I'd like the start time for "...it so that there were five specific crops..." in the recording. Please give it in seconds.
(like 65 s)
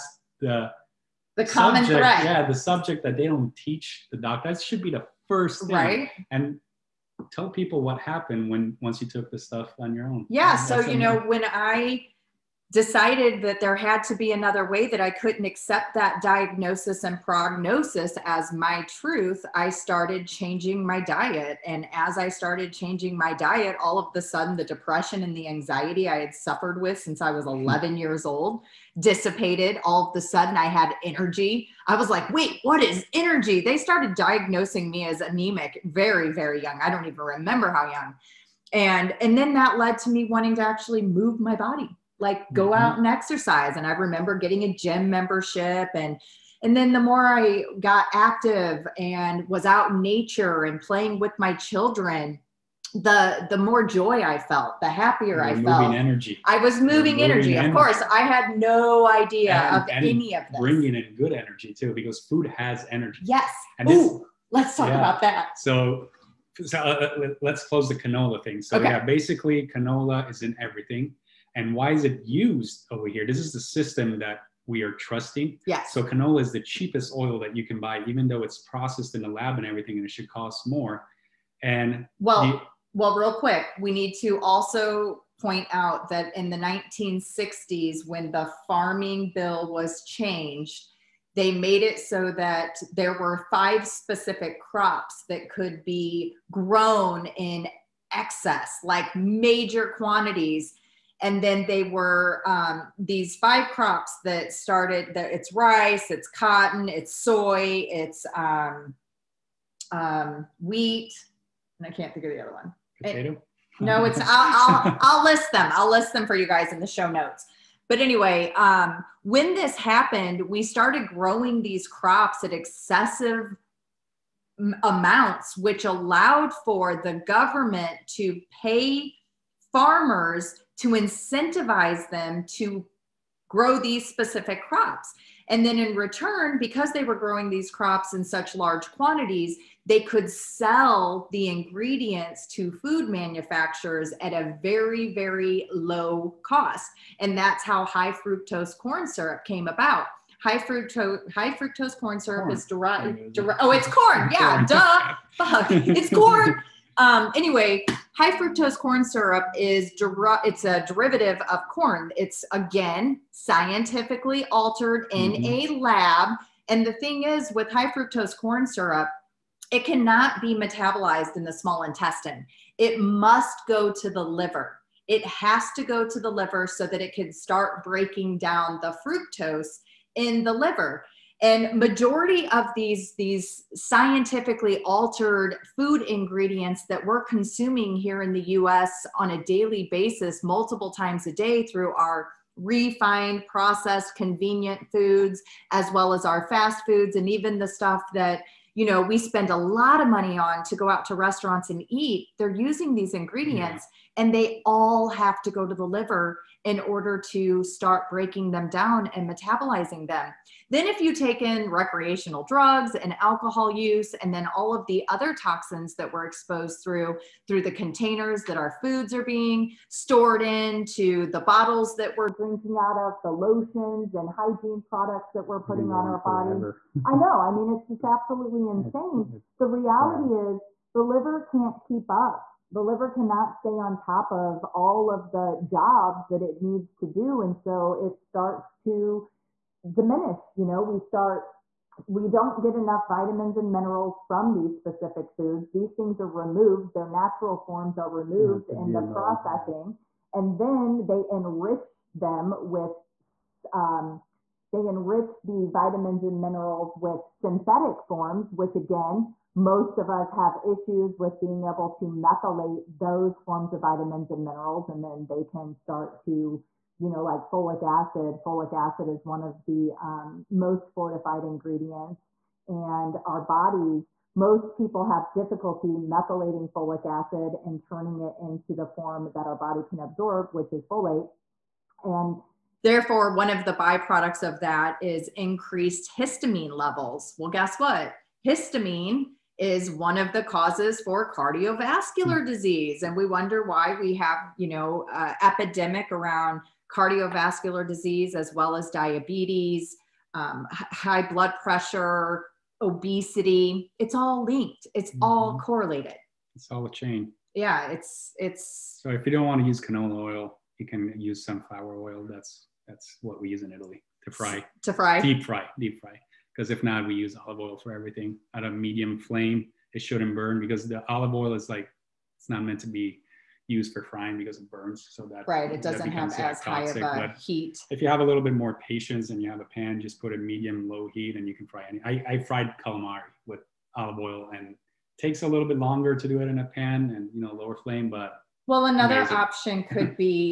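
91 s.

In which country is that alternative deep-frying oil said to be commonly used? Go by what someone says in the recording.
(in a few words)
Italy.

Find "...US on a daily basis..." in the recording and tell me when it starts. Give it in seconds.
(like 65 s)
188 s.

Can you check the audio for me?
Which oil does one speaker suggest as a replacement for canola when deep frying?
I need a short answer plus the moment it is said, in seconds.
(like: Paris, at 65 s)
Sunflower oil, at 311 s.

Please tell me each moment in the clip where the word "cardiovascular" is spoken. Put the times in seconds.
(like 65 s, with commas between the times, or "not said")
291 s, 296 s.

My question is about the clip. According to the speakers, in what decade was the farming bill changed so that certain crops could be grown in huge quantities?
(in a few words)
1960s.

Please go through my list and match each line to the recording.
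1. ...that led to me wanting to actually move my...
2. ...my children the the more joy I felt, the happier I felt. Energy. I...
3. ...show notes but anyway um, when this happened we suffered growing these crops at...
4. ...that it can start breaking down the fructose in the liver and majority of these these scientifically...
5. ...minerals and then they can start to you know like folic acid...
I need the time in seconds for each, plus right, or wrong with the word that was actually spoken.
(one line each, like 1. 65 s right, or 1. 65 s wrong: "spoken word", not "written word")
1. 39 s right
2. 51 s right
3. 116 s wrong: "started", not "suffered"
4. 176 s right
5. 264 s right.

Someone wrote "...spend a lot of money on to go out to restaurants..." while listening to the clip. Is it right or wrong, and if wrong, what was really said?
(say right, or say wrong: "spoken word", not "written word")
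right.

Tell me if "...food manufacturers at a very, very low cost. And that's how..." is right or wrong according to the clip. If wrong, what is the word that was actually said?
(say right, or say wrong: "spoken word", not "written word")
right.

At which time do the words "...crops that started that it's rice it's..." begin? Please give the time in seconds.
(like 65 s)
103 s.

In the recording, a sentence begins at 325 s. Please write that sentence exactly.
So that right, it doesn't have as toxic.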